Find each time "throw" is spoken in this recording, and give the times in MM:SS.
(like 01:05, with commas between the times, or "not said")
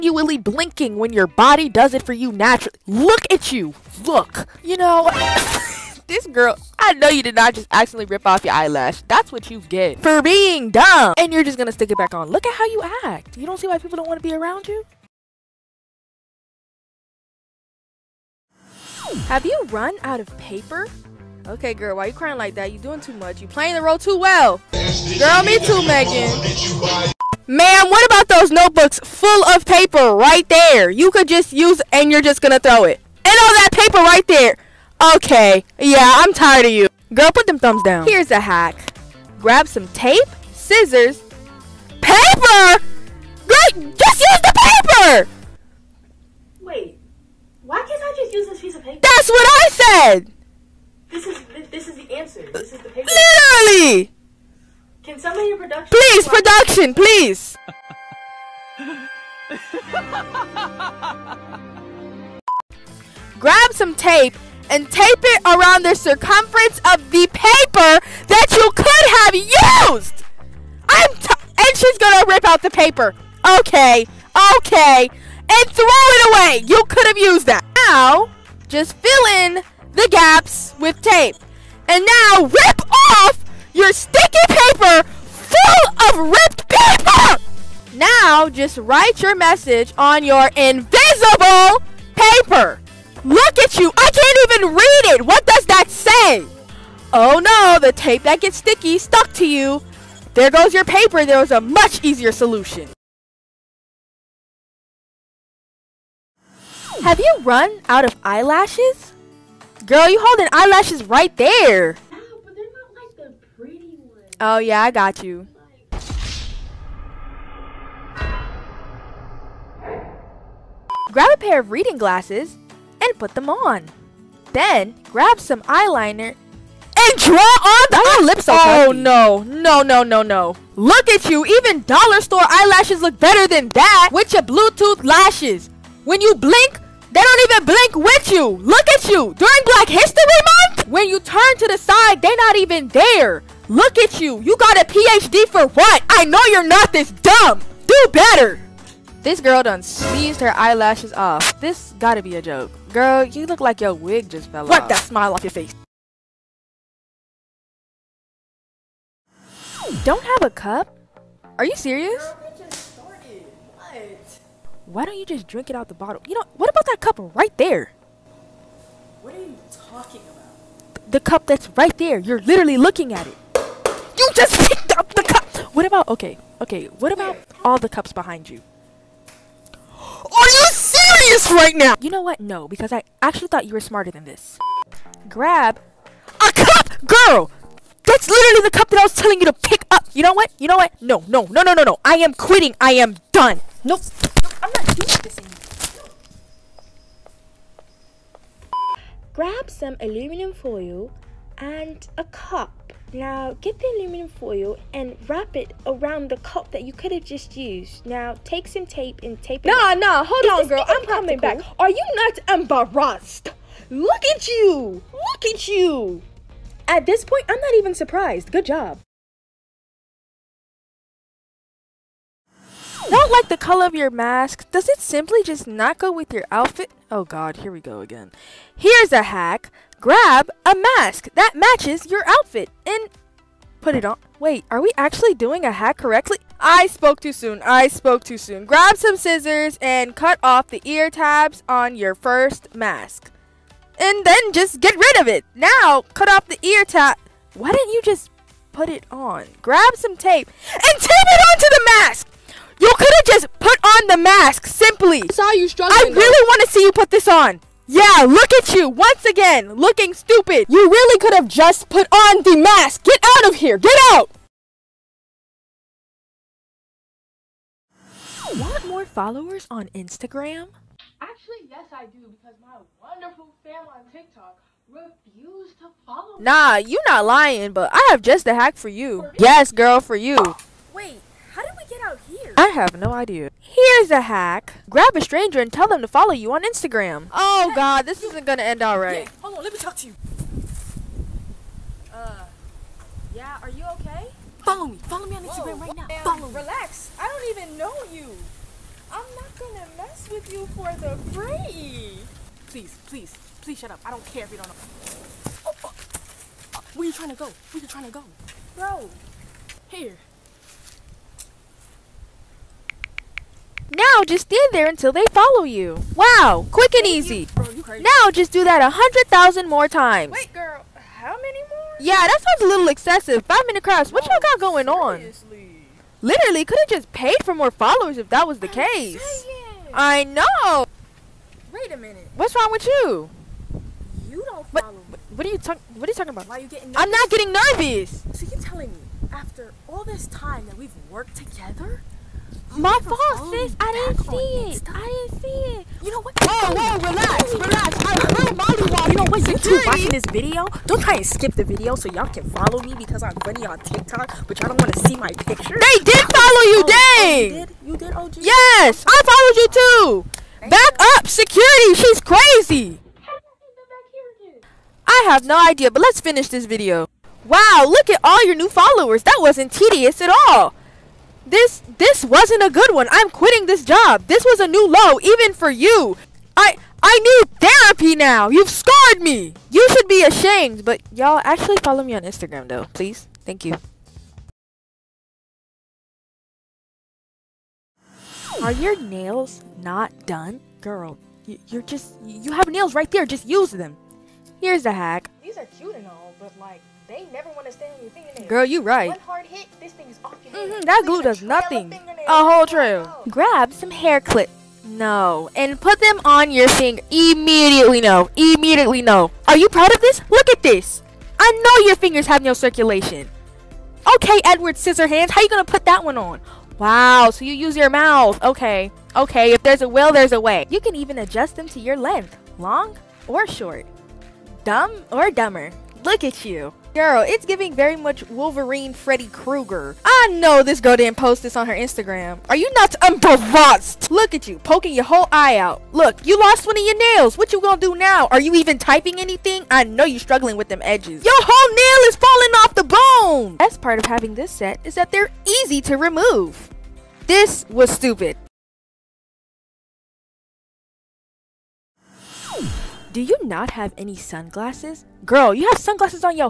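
00:32, 01:15.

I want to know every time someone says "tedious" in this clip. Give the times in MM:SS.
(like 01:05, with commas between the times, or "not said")
06:09.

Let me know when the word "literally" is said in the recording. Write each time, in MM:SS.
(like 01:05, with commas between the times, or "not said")
00:53, 02:52, 03:08, 05:26.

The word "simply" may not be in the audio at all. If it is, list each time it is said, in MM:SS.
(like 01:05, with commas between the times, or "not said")
03:44, 04:14.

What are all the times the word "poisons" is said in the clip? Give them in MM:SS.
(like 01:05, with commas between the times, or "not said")
not said.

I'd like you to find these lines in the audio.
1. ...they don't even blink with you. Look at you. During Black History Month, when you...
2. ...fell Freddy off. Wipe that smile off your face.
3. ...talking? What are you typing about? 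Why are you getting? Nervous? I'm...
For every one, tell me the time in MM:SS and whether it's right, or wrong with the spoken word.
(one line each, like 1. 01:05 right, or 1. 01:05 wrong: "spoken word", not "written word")
1. 02:17 right
2. 02:34 wrong: "Wipe", not "Freddy"
3. 05:35 wrong: "talking", not "typing".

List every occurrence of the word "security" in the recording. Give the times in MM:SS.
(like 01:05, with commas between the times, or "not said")
06:01.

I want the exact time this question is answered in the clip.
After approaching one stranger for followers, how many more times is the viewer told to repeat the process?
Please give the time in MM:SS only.
05:18.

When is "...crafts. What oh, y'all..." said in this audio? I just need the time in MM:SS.
05:23.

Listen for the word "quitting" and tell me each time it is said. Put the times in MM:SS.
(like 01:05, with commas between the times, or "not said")
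03:12, 06:13.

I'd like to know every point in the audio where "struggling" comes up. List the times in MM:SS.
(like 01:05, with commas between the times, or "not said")
04:15, 07:20.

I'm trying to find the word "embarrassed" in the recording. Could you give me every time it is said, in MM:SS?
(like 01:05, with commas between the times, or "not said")
03:32, 07:13.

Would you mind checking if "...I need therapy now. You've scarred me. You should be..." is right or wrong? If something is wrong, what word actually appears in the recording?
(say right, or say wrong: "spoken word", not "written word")
right.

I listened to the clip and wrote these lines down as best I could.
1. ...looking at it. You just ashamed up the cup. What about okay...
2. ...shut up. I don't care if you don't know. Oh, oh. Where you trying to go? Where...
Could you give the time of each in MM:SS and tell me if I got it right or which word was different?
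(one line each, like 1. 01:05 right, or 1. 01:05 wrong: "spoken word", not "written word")
1. 02:52 wrong: "picked", not "ashamed"
2. 05:03 right.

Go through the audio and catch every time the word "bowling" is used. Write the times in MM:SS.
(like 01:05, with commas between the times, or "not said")
not said.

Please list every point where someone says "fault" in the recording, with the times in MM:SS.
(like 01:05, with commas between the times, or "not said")
05:43.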